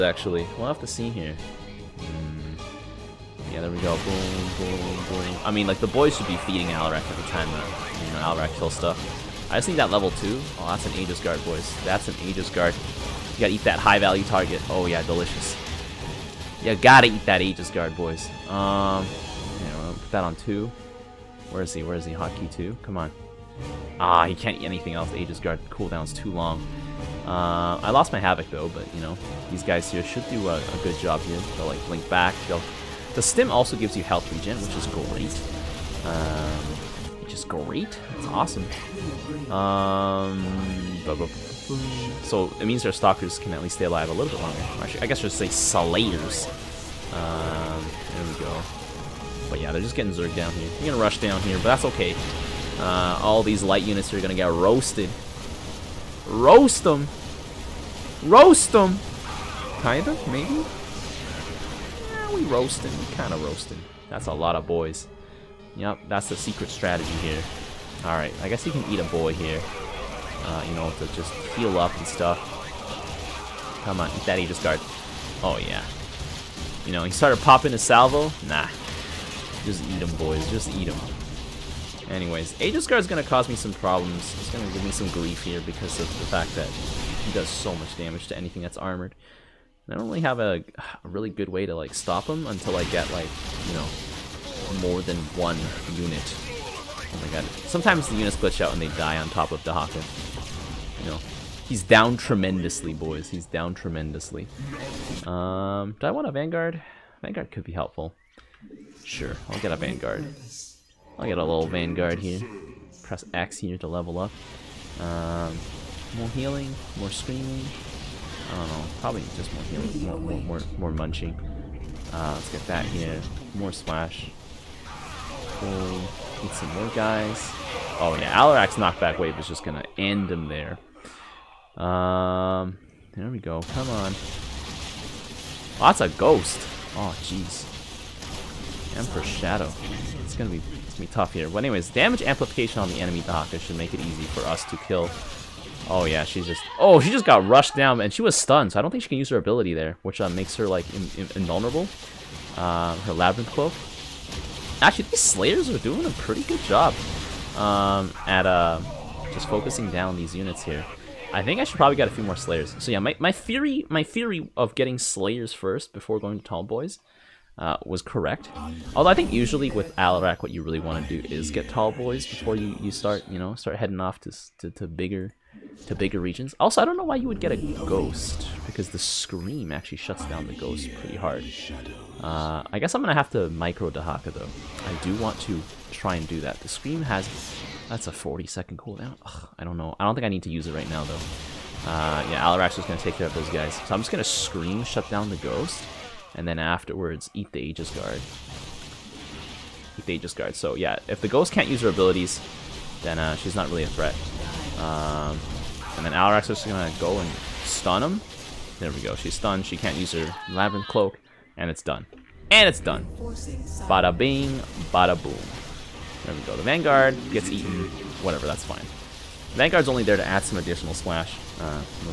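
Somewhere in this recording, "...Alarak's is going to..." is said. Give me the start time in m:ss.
3:12.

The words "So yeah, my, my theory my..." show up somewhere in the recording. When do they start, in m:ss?
2:42.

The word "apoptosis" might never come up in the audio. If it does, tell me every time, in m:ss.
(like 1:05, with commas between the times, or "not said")
not said.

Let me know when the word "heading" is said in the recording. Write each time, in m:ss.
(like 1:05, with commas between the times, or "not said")
2:53.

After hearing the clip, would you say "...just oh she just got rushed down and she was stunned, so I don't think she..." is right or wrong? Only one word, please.
right.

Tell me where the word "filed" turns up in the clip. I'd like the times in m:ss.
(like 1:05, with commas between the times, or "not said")
not said.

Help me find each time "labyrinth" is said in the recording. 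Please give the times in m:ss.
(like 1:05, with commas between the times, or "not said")
2:33, 3:30.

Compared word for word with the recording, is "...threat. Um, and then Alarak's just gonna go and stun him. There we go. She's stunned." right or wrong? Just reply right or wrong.
right.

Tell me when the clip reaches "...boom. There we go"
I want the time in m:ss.
3:35.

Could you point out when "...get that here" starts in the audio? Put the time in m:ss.
2:02.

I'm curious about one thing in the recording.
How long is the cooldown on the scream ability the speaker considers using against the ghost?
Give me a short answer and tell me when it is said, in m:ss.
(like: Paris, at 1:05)
40 seconds, at 3:08.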